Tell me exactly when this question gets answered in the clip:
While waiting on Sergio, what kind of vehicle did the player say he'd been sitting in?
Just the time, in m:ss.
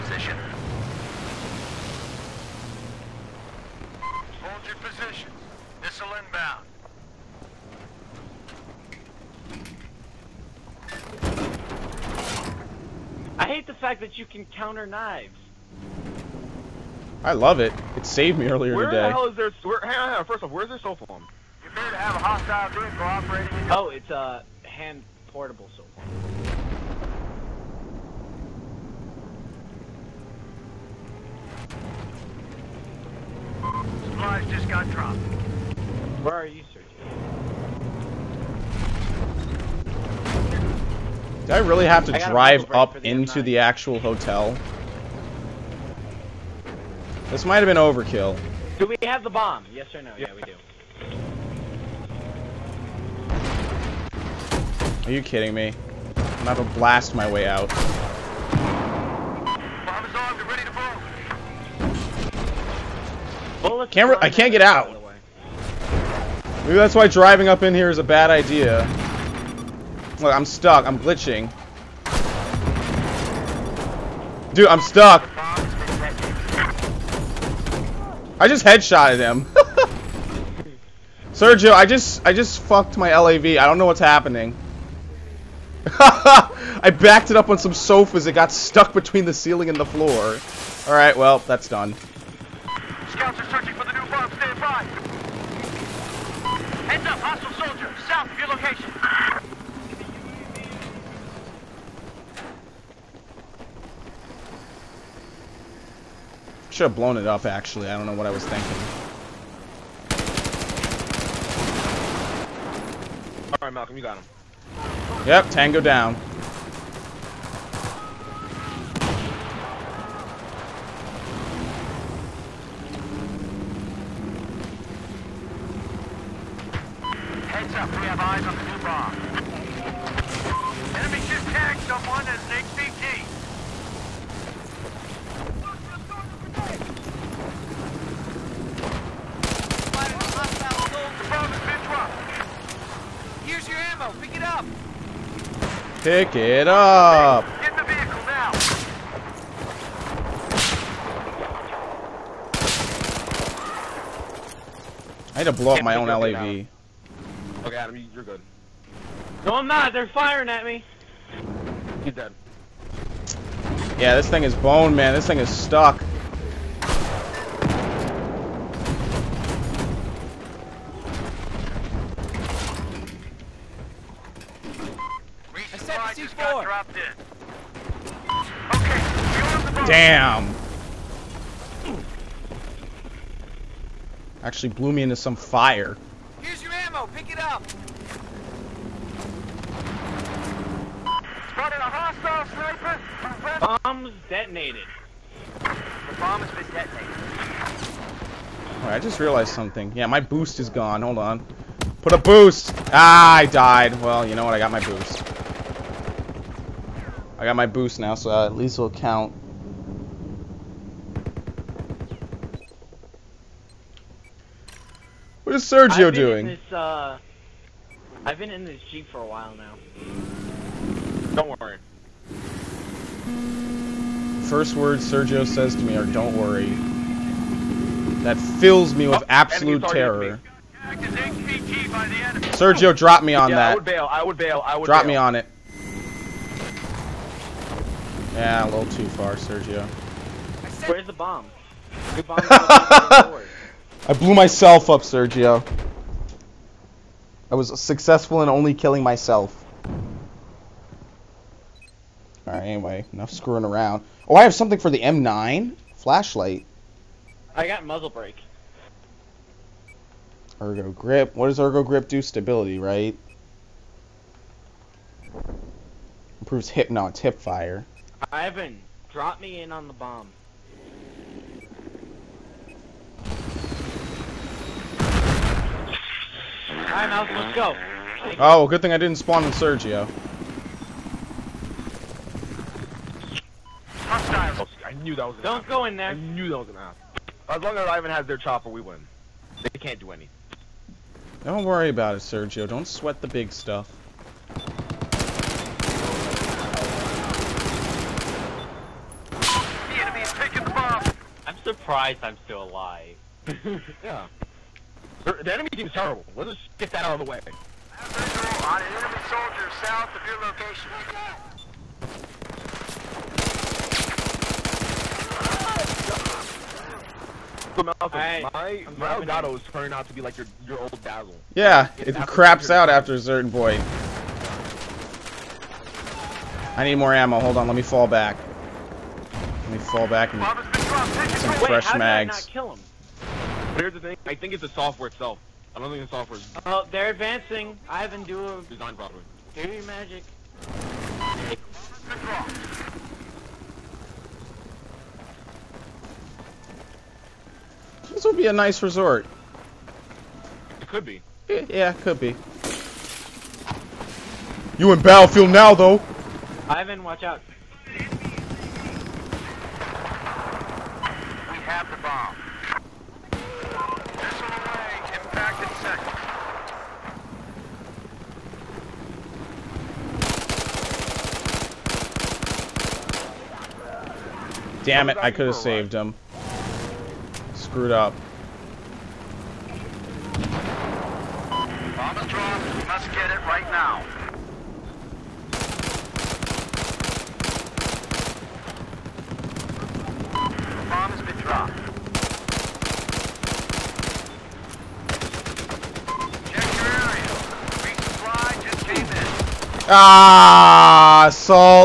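3:38.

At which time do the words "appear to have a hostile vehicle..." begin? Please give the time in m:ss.
0:21.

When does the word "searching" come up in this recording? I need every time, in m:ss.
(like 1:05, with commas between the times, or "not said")
0:36, 1:33.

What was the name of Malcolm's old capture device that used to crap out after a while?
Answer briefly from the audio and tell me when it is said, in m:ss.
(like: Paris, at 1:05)
Dazzle, at 5:21.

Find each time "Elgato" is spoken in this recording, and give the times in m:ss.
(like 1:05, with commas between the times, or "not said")
5:19.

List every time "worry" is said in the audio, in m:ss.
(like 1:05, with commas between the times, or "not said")
3:41, 3:46, 4:51.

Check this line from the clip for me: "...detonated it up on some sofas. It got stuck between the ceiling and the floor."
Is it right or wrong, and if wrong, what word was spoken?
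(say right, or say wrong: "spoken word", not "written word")
wrong: "backed", not "detonated".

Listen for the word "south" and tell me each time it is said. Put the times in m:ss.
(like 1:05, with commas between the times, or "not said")
1:38, 5:09.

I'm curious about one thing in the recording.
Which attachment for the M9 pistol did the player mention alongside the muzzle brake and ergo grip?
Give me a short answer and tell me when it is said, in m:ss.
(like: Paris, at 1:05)
Flashlight, at 4:15.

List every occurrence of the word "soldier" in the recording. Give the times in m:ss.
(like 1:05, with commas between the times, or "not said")
1:37, 5:09.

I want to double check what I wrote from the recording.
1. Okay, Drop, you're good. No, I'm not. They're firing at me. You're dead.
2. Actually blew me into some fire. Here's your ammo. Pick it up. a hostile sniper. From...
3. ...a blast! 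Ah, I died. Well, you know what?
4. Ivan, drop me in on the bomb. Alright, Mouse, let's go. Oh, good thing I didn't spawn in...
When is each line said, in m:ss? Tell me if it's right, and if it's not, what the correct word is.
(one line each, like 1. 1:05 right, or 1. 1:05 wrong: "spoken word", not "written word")
1. 2:37 wrong: "Adam", not "Drop"
2. 3:04 right
3. 3:22 wrong: "boost", not "blast"
4. 4:28 right.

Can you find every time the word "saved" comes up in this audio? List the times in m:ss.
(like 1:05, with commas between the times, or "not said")
0:18, 6:15.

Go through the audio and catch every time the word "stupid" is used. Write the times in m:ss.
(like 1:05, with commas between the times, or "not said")
not said.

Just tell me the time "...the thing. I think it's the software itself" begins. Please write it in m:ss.
5:33.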